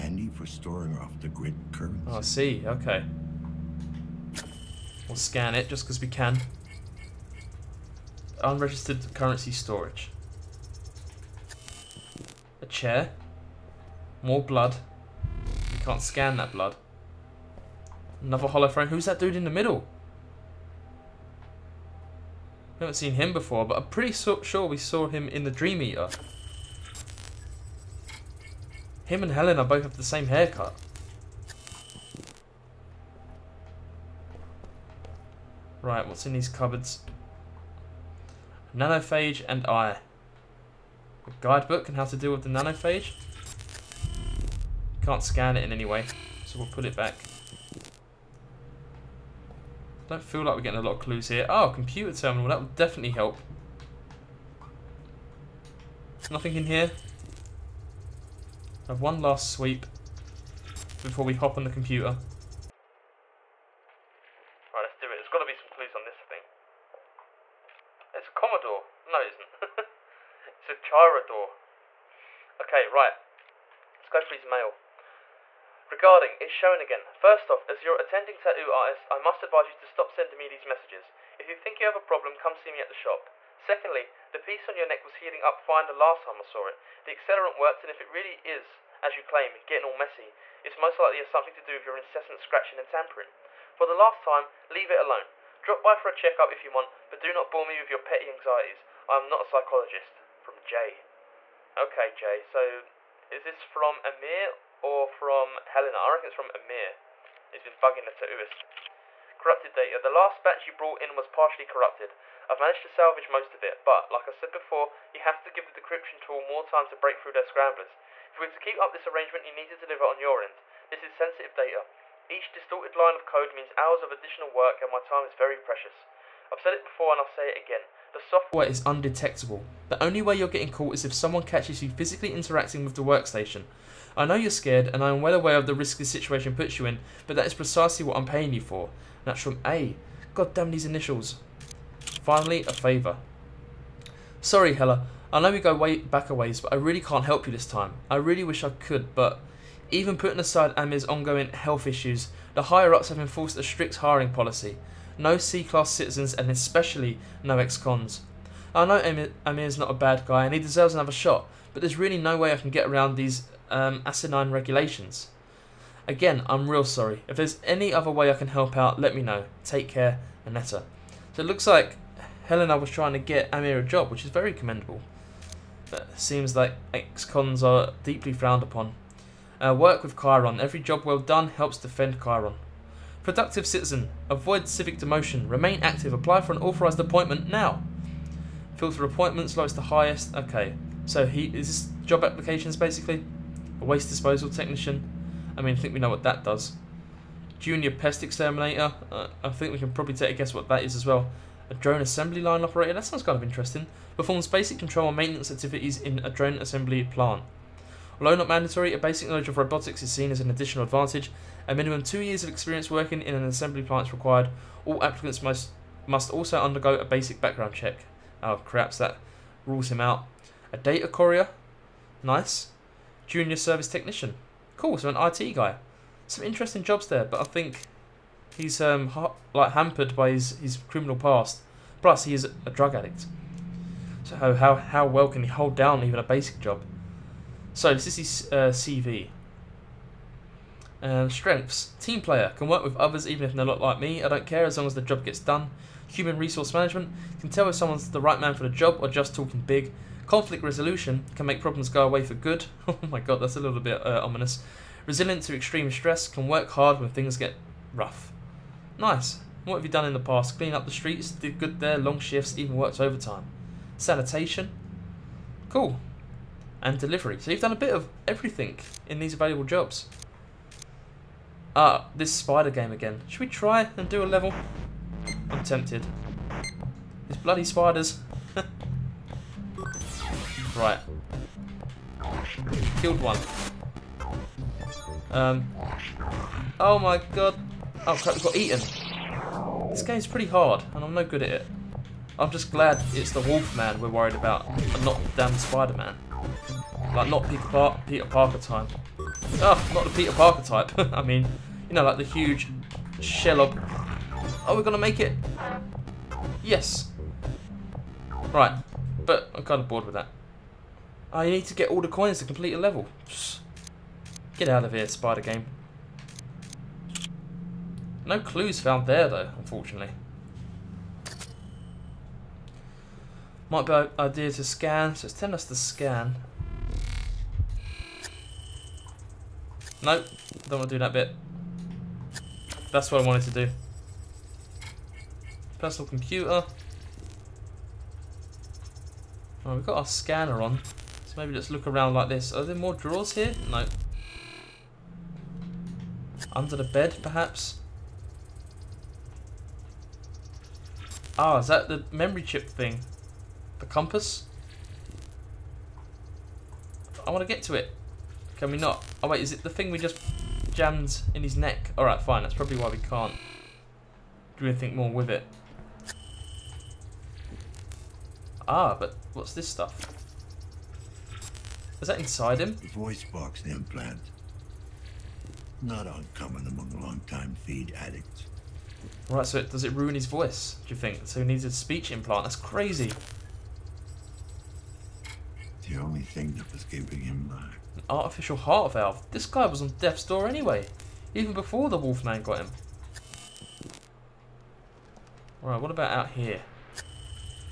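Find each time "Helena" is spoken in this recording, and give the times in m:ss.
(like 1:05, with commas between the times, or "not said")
0:29, 1:45, 2:52.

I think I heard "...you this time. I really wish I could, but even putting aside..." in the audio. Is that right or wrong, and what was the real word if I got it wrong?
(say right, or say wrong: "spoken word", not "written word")
right.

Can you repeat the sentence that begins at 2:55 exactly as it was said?
But it seems like ex-cons are deeply frowned upon.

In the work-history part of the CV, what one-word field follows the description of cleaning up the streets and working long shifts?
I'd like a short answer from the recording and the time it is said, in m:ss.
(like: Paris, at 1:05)
Sanitation, at 4:23.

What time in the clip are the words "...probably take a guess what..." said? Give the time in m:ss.
3:19.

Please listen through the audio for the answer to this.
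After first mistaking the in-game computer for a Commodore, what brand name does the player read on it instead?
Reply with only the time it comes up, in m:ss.
1:10.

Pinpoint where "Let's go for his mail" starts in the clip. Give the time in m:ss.
1:13.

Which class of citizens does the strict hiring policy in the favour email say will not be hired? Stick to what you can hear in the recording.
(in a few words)
C-class.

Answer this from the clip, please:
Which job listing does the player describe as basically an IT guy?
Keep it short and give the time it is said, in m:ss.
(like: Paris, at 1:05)
Junior service technician, at 3:43.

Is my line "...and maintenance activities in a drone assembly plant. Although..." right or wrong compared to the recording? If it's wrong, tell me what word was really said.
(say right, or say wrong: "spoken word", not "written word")
right.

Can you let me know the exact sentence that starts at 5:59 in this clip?
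Oh wait, is it the thing we just jammed in his neck?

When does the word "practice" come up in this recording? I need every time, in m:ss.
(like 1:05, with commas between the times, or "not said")
not said.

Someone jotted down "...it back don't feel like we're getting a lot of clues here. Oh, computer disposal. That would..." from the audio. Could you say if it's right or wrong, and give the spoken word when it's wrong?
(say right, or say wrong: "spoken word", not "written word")
wrong: "terminal", not "disposal".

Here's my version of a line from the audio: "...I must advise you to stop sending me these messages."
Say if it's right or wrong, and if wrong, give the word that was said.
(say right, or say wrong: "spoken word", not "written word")
right.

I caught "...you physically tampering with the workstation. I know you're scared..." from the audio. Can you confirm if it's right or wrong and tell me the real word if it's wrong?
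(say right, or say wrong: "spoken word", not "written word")
wrong: "interacting", not "tampering".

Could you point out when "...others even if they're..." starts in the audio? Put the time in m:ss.
4:02.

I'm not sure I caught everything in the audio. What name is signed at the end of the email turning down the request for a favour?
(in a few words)
Anetta.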